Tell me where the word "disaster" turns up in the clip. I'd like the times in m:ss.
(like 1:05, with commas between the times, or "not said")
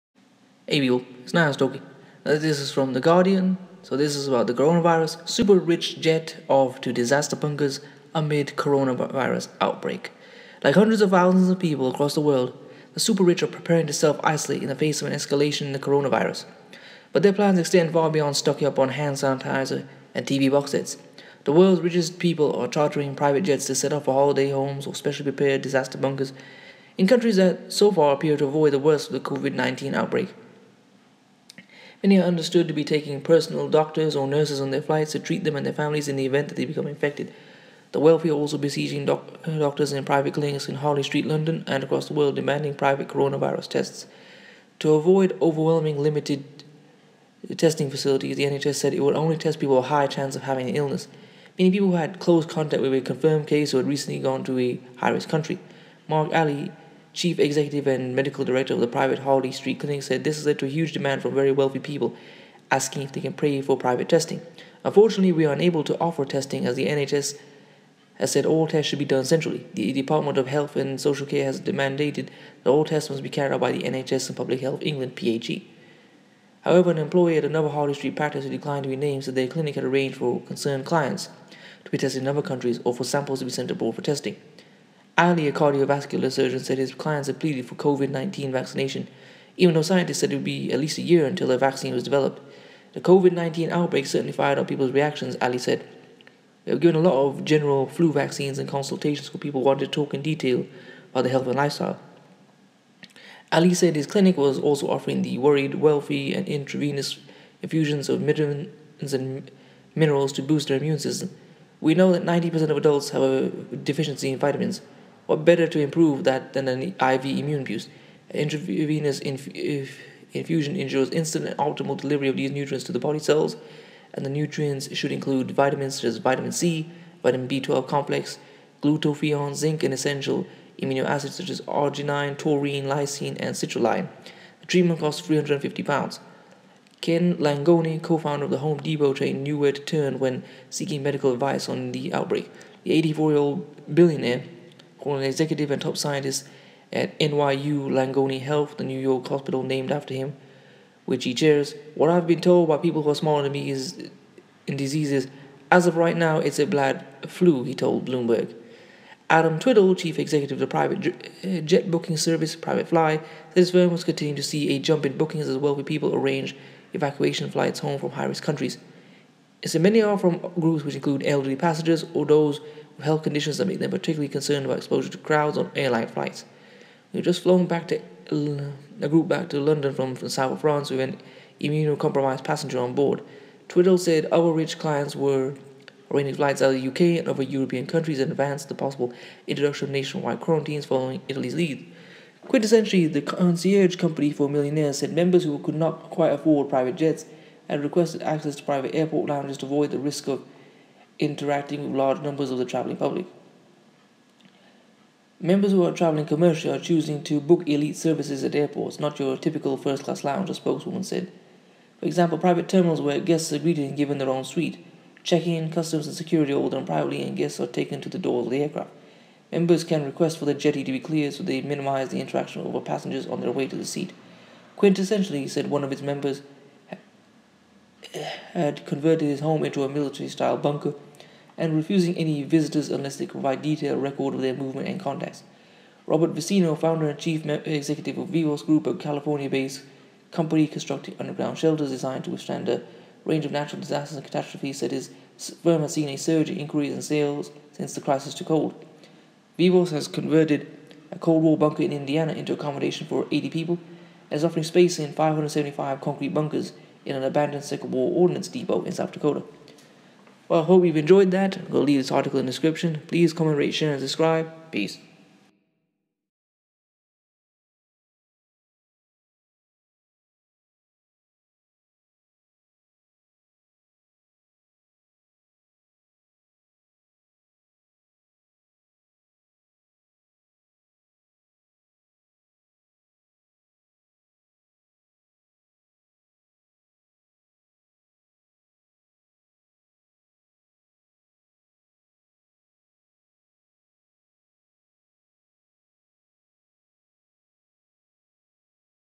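0:06, 0:25, 4:03.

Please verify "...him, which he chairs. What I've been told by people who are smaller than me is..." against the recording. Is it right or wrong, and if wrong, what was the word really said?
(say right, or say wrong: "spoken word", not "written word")
right.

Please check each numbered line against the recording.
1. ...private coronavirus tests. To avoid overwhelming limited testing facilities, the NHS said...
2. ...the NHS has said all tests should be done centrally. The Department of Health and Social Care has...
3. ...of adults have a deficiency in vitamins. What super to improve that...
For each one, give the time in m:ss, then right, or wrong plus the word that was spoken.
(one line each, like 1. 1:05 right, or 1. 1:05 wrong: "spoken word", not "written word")
1. 0:42 right
2. 1:06 right
3. 1:52 wrong: "better", not "super".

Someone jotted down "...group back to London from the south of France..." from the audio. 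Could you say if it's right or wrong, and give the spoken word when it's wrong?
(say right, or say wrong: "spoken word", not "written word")
right.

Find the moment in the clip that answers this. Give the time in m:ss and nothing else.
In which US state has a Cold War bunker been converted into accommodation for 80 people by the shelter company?
4:11.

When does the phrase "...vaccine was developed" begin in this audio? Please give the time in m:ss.
1:31.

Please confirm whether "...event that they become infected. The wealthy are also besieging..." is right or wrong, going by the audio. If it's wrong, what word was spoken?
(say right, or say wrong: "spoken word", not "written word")
right.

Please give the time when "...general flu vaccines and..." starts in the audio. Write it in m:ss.
1:37.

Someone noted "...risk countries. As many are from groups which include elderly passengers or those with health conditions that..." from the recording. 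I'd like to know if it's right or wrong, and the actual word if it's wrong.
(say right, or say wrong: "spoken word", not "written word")
right.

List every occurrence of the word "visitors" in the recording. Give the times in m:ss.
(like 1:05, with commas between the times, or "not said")
3:52.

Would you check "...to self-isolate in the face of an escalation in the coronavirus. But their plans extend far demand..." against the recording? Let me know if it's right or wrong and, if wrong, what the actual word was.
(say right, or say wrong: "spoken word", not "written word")
wrong: "beyond", not "demand".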